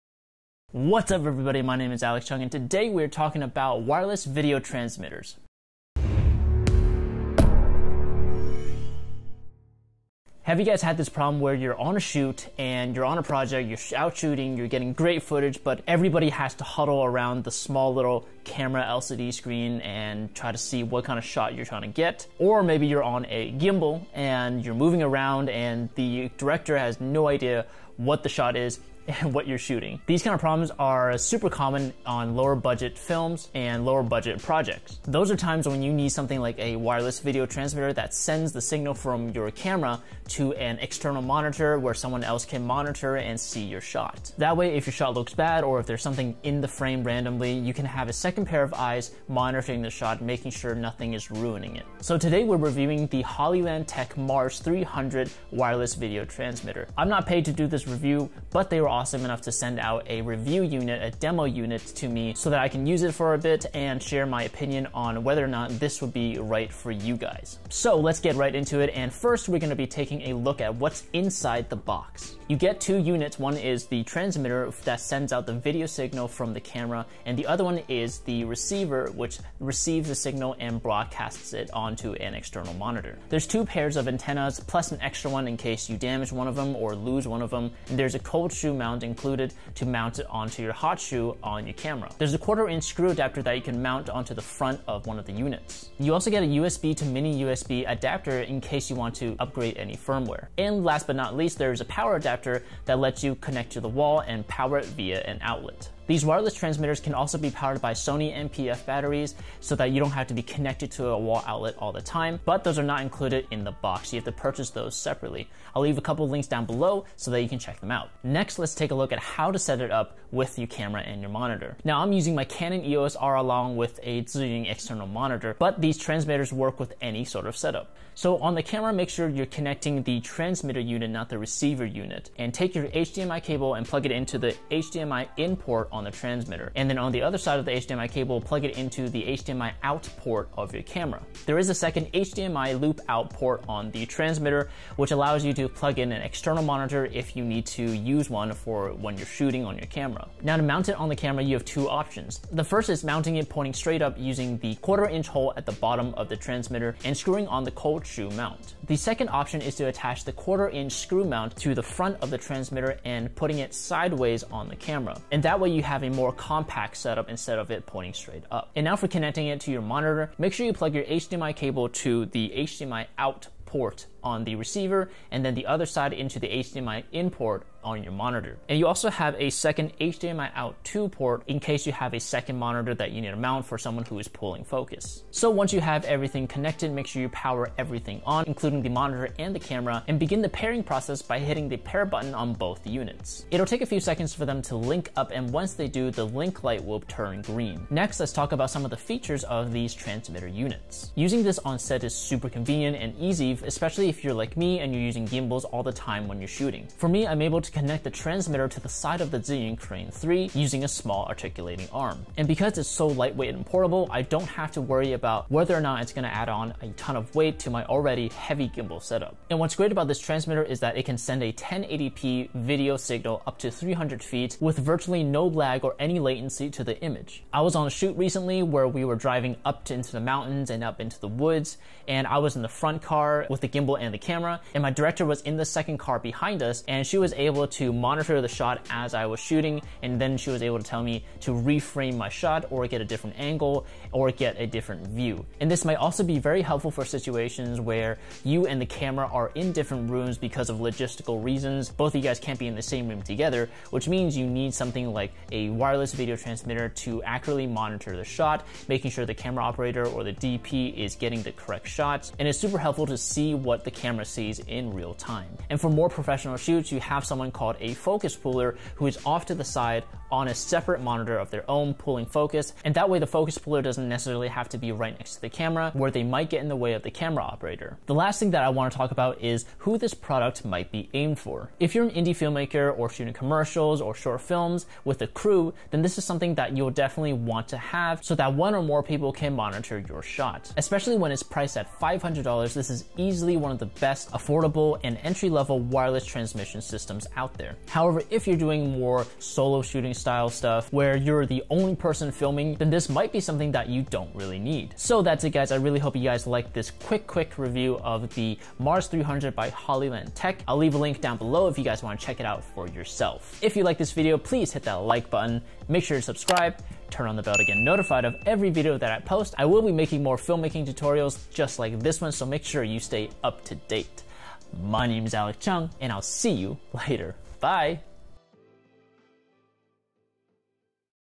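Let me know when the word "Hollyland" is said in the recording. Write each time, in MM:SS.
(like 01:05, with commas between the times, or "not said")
00:53, 05:09.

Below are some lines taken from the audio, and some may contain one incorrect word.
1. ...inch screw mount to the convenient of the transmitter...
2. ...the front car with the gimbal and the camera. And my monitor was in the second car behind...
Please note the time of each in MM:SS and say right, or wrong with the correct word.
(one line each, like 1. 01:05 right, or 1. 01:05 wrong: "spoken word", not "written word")
1. 02:40 wrong: "front", not "convenient"
2. 03:52 wrong: "director", not "monitor".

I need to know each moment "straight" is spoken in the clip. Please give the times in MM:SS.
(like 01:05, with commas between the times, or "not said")
02:33, 02:48.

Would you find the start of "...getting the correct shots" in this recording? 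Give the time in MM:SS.
04:21.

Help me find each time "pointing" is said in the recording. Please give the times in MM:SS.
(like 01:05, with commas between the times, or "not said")
02:33, 02:47.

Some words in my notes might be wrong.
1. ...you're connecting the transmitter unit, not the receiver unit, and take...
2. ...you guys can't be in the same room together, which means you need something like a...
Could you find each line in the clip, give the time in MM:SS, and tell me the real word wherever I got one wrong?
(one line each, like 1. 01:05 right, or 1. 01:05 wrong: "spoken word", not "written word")
1. 02:09 right
2. 04:12 right.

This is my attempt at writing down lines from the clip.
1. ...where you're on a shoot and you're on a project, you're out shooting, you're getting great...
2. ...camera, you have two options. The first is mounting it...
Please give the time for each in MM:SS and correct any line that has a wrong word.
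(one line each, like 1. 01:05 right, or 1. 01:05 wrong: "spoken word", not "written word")
1. 00:11 right
2. 02:31 right.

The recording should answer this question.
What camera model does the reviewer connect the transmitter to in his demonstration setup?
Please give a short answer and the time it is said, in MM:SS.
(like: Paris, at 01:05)
Canon EOS R, at 02:02.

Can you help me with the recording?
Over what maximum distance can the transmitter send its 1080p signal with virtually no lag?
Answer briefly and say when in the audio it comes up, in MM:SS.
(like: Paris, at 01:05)
300 feet, at 03:43.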